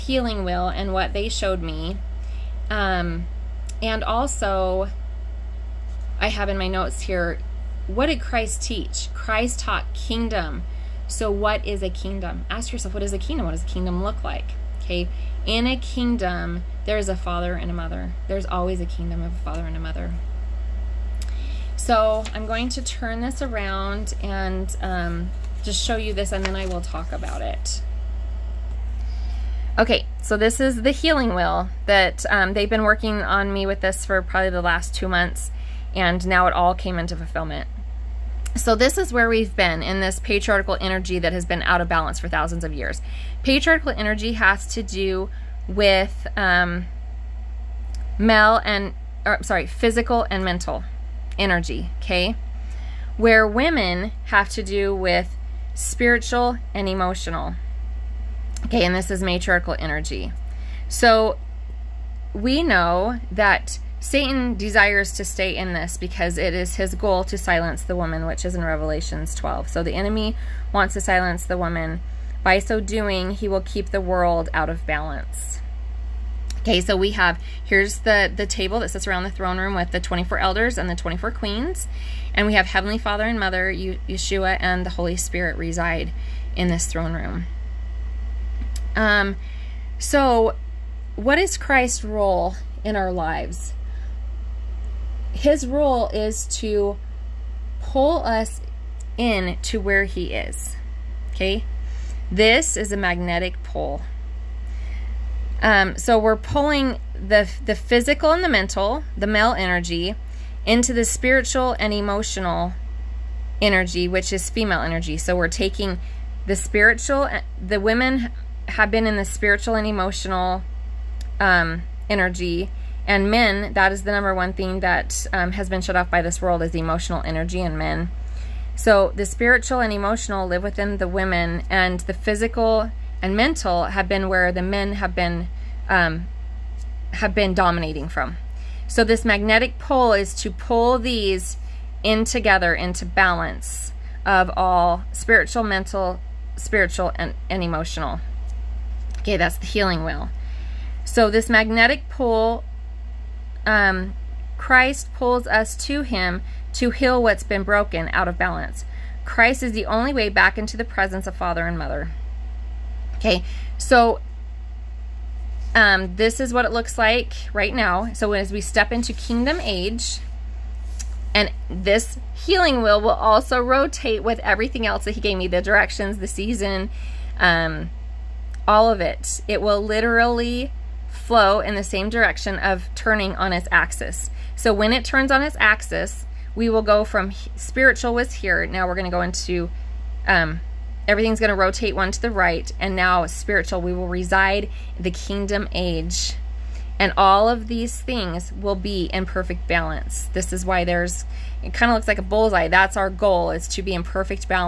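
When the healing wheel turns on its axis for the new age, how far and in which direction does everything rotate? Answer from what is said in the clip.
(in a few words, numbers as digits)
one to the right.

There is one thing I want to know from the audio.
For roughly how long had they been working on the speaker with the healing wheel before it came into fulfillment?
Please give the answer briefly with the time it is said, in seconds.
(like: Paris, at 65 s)
two months, at 34 s.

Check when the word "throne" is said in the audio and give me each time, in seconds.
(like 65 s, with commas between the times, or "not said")
79 s, 86 s.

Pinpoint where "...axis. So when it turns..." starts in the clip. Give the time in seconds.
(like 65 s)
183 s.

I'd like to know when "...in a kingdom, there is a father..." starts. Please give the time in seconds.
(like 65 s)
15 s.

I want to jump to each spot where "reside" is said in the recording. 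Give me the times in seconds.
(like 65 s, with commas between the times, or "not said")
85 s, 194 s.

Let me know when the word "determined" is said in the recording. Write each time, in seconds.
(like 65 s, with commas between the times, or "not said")
not said.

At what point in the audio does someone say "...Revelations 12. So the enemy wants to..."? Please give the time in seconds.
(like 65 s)
68 s.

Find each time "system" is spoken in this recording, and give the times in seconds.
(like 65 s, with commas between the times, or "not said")
not said.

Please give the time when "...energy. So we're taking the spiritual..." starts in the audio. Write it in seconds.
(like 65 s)
114 s.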